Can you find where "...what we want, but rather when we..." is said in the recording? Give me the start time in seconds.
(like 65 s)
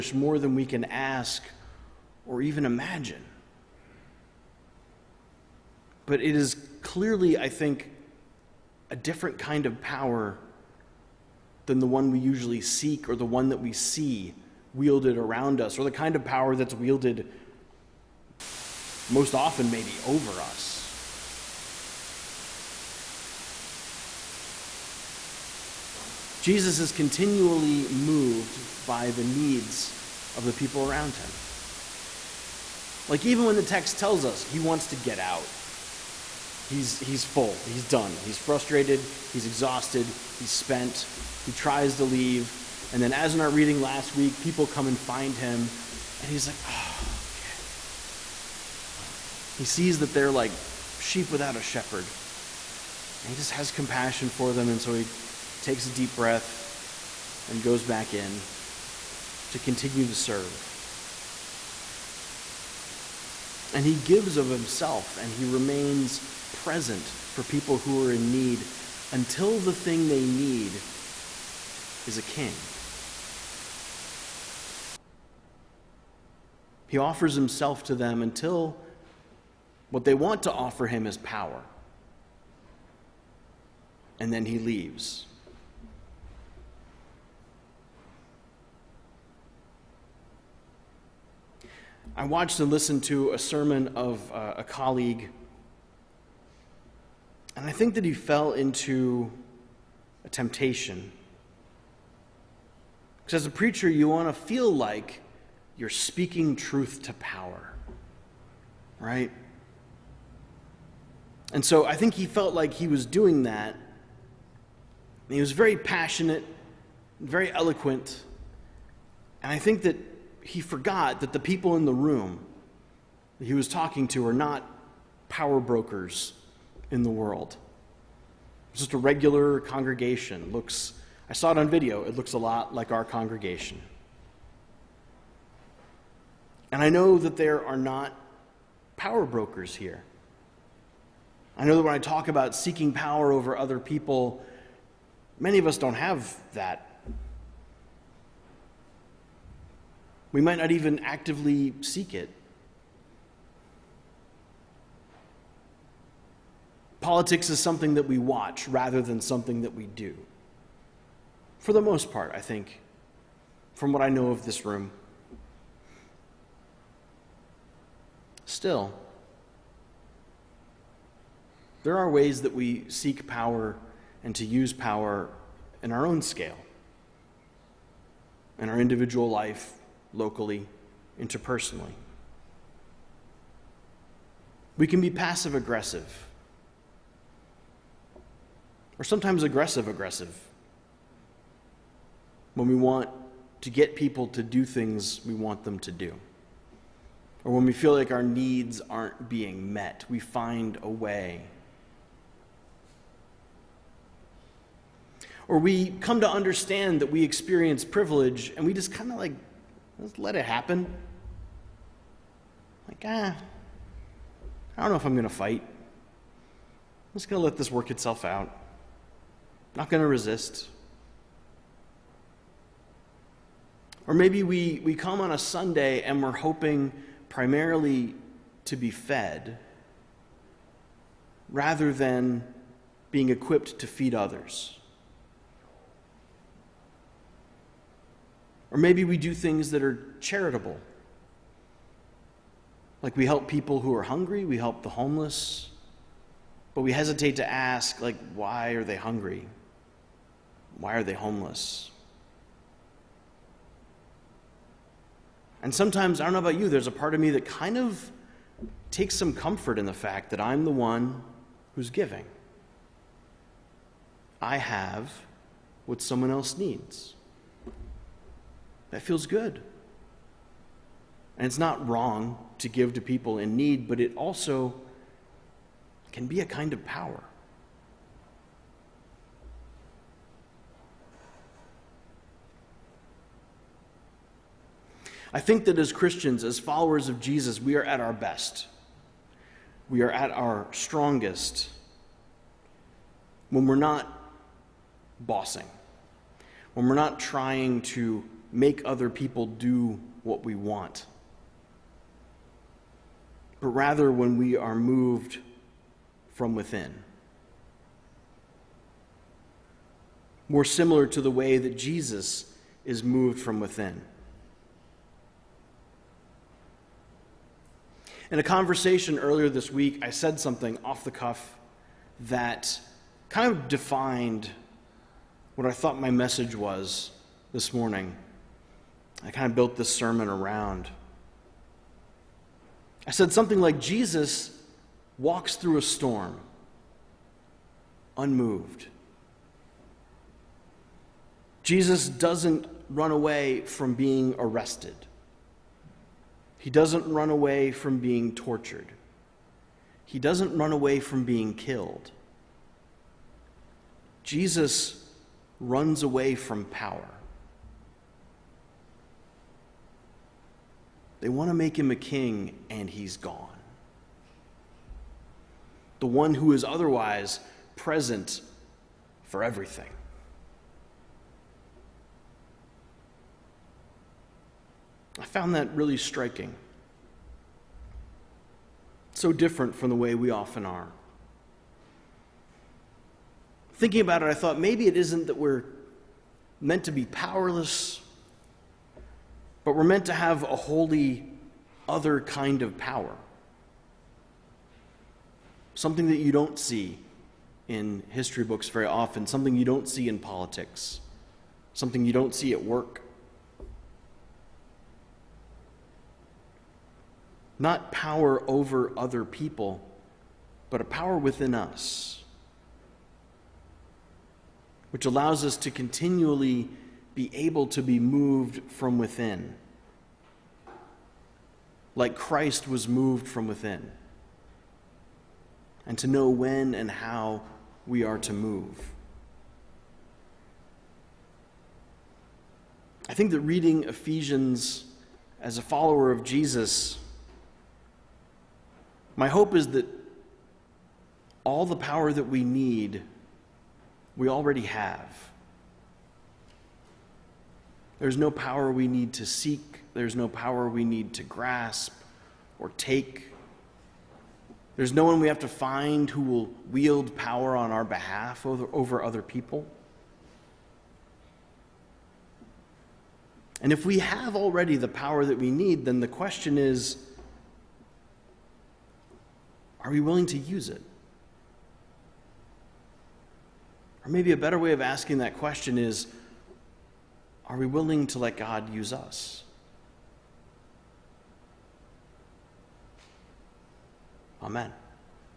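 300 s.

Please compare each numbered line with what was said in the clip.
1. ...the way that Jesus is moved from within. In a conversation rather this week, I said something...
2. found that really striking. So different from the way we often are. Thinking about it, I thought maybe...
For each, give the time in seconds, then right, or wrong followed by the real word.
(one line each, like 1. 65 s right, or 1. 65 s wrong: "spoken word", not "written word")
1. 311 s wrong: "earlier", not "rather"
2. 375 s right.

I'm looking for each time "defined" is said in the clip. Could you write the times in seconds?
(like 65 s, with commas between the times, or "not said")
323 s.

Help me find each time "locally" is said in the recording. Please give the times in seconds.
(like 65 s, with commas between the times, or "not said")
180 s.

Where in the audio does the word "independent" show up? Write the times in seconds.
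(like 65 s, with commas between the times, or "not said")
not said.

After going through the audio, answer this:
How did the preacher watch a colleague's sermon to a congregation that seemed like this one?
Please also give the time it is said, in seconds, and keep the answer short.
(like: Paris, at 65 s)
video, at 131 s.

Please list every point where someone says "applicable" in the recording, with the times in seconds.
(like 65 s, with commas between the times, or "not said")
not said.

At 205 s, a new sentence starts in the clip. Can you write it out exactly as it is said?
Or we come to understand that we experience privilege and we just kind of like, just let it happen.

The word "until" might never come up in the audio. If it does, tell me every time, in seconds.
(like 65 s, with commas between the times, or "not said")
69 s, 78 s.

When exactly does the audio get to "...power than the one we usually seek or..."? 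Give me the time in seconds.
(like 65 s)
9 s.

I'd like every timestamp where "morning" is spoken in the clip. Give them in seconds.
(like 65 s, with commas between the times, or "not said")
327 s.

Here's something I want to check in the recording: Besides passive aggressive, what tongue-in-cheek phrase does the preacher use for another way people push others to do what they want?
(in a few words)
aggressive aggressive.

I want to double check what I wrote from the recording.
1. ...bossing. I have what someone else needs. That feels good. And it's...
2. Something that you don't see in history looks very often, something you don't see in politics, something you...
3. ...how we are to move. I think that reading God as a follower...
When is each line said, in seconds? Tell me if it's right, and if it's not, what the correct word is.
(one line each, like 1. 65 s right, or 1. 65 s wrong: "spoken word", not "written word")
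1. 261 s wrong: "giving", not "bossing"
2. 395 s wrong: "books", not "looks"
3. 426 s wrong: "Ephesians", not "God".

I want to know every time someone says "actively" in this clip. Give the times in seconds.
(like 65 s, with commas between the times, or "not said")
150 s.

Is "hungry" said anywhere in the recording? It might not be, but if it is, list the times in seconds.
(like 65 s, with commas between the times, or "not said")
244 s, 248 s.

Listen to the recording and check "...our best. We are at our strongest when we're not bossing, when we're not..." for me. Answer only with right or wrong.
right.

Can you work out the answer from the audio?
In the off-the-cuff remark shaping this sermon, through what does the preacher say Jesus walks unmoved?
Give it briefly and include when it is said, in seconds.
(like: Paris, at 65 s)
a storm, at 335 s.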